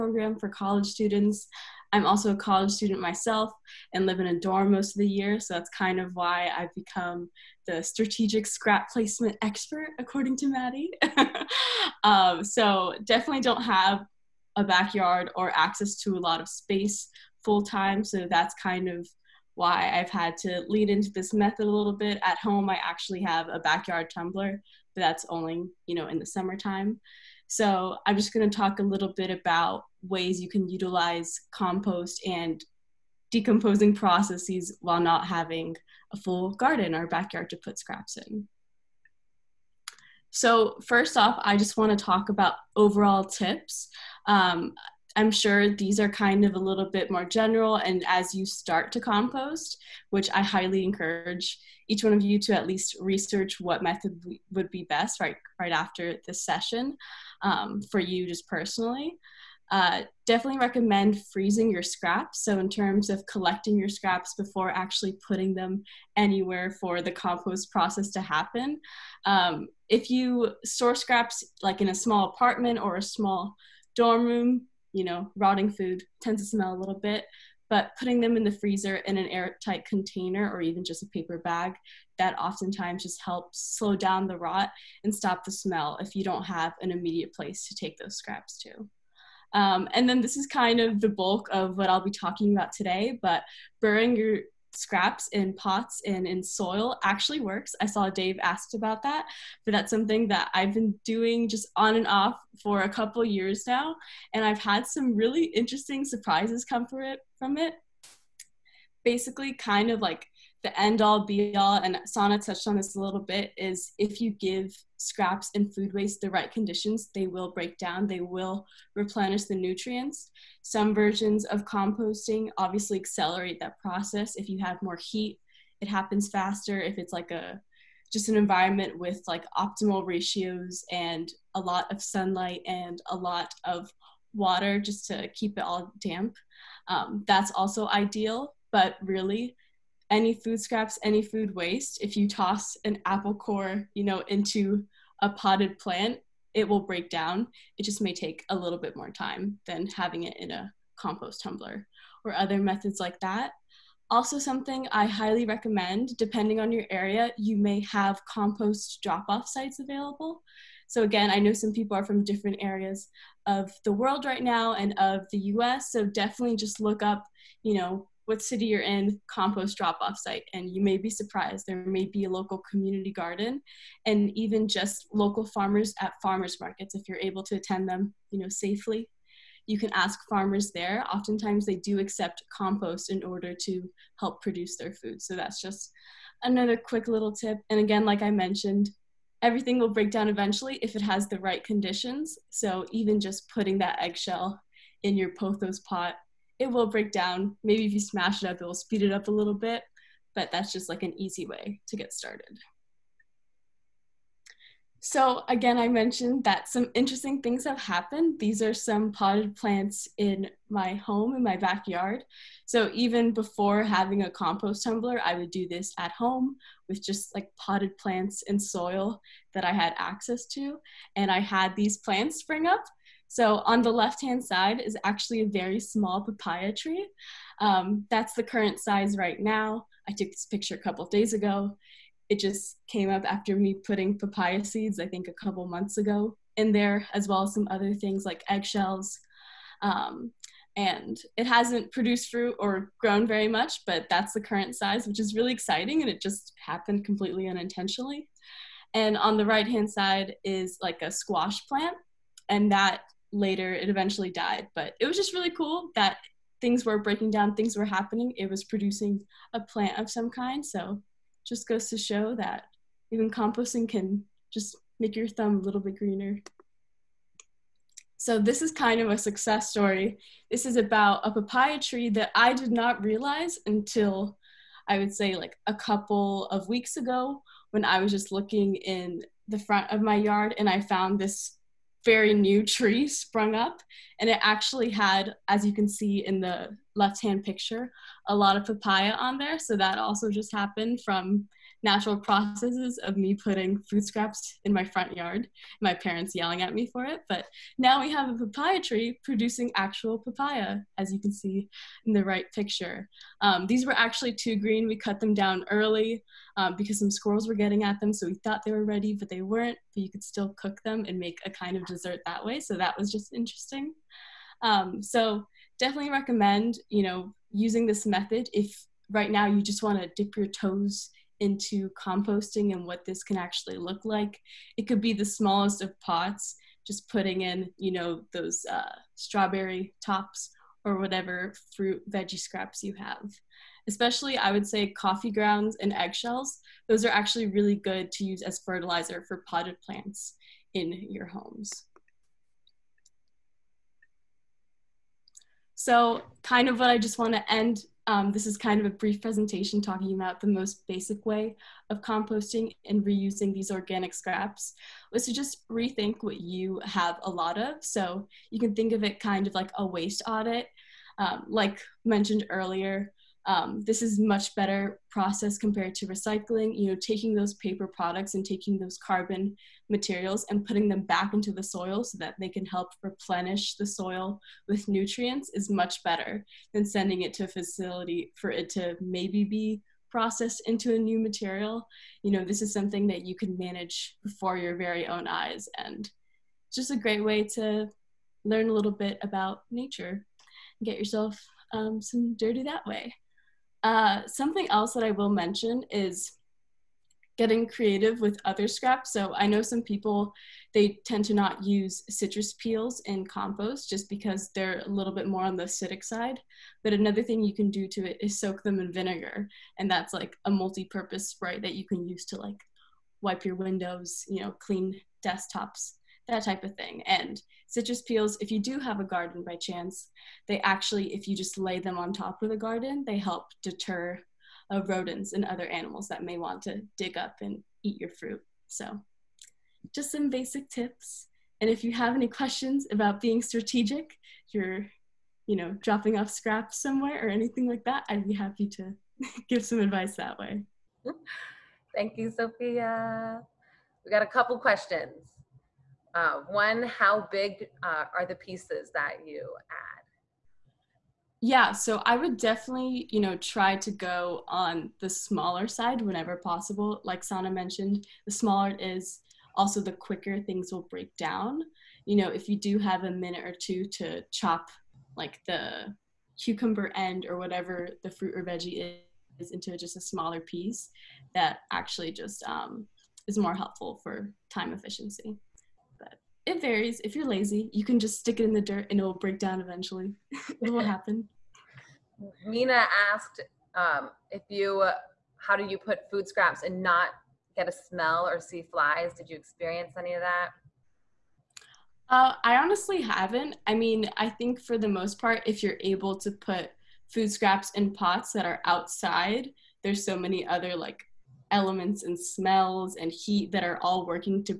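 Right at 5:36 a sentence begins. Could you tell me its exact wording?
Those are actually really good to use as fertilizer for potted plants in your homes.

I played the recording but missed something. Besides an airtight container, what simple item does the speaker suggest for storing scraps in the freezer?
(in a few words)
Paper bag.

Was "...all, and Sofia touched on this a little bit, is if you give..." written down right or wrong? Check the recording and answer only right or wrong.
wrong.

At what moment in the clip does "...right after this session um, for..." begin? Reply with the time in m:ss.
0:55.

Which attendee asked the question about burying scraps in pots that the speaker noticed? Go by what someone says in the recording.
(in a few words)
Dave.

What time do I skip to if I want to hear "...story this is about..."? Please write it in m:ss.
4:29.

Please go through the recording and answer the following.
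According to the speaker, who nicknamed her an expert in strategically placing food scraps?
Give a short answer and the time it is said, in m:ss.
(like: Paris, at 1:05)
Maddie, at 0:10.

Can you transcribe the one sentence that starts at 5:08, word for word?
So we thought they were ready, but they weren't.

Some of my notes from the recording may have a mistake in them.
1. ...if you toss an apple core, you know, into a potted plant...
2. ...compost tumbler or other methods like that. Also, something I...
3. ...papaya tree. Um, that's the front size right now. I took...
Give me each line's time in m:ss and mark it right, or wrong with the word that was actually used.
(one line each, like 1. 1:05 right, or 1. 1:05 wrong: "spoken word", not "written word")
1. 2:22 right
2. 2:30 right
3. 3:46 wrong: "current", not "front".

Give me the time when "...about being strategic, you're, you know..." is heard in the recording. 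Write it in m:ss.
7:12.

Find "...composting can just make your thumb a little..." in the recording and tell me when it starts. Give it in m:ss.
4:23.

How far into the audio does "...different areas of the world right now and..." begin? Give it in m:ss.
2:42.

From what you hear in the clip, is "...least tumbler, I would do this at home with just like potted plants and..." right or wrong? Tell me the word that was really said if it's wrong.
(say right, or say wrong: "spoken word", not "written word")
wrong: "compost", not "least".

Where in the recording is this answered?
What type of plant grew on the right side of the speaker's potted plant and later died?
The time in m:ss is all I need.
4:11.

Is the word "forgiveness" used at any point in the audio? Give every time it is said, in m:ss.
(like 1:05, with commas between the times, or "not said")
not said.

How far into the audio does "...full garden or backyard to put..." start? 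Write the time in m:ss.
0:36.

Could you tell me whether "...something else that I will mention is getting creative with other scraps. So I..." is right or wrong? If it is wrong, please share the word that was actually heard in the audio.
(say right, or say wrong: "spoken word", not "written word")
right.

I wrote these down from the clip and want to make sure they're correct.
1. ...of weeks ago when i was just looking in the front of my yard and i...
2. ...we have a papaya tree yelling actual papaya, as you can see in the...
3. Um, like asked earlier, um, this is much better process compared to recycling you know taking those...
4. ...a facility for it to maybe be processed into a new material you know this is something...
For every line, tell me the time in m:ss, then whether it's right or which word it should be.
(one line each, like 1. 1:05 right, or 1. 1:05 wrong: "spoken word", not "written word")
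1. 4:36 right
2. 4:57 wrong: "producing", not "yelling"
3. 6:01 wrong: "mentioned", not "asked"
4. 6:17 right.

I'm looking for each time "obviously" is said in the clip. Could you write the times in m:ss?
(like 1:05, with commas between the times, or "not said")
2:02.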